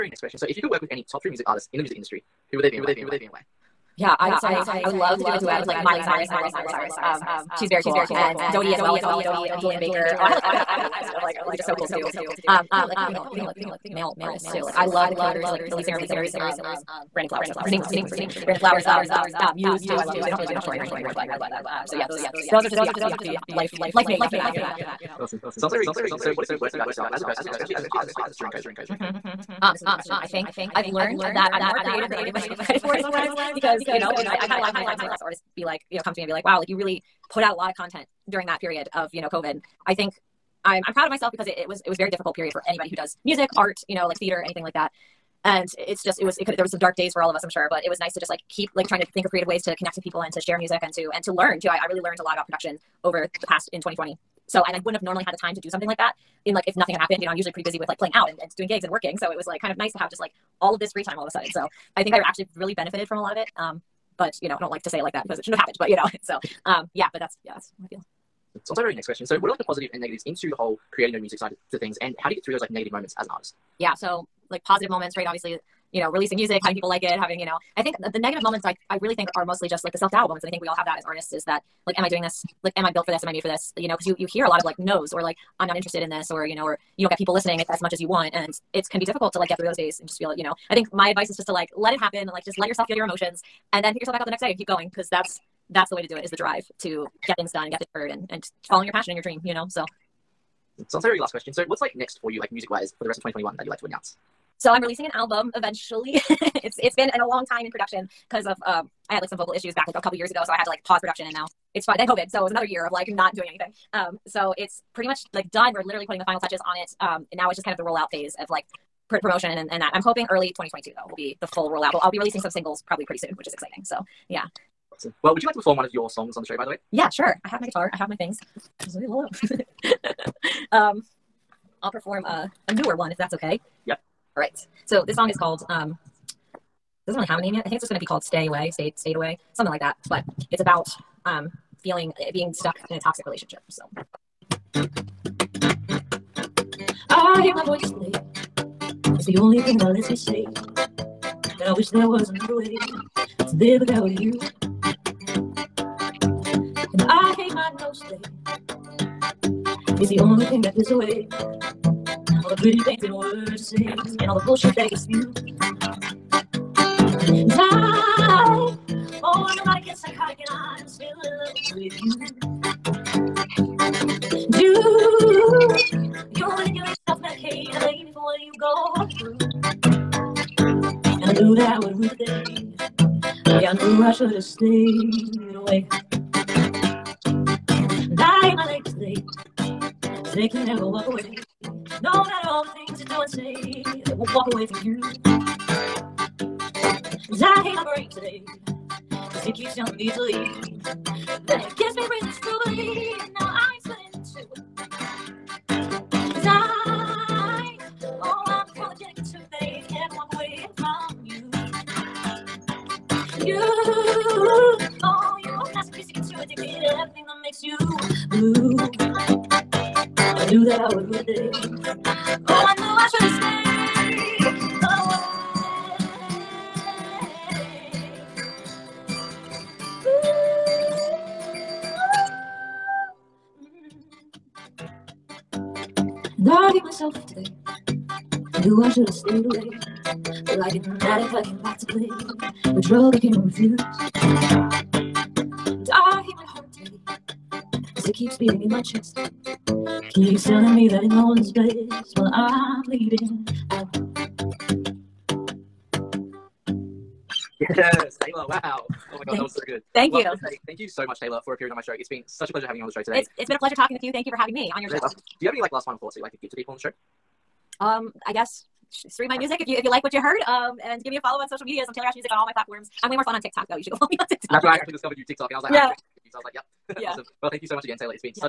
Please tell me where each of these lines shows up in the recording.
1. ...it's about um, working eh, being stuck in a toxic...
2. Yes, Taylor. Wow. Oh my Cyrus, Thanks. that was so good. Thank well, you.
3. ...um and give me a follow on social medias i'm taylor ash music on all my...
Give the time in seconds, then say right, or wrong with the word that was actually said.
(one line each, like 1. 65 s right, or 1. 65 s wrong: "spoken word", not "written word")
1. 140 s wrong: "feeling", not "working"
2. 257 s wrong: "God", not "Cyrus"
3. 270 s right.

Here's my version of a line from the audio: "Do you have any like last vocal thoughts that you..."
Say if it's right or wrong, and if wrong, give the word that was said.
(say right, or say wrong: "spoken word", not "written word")
wrong: "final", not "vocal".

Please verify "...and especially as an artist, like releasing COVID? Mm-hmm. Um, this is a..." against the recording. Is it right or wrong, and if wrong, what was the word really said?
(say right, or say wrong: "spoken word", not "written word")
wrong: "during", not "releasing".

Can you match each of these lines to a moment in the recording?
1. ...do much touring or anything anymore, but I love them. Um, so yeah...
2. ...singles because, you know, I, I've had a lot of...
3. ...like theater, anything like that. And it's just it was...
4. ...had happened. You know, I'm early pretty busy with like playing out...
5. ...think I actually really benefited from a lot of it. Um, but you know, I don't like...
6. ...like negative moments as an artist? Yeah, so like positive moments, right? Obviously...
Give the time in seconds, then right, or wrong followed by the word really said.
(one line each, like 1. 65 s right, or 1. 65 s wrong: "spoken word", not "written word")
1. 20 s right
2. 32 s wrong: "sometimes", not "singles"
3. 44 s right
4. 56 s wrong: "usually", not "early"
5. 62 s right
6. 72 s right.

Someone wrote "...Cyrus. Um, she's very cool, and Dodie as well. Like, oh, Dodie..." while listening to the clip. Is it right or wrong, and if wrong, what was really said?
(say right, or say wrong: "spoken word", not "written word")
right.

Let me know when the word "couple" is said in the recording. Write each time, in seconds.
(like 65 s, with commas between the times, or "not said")
12 s, 109 s.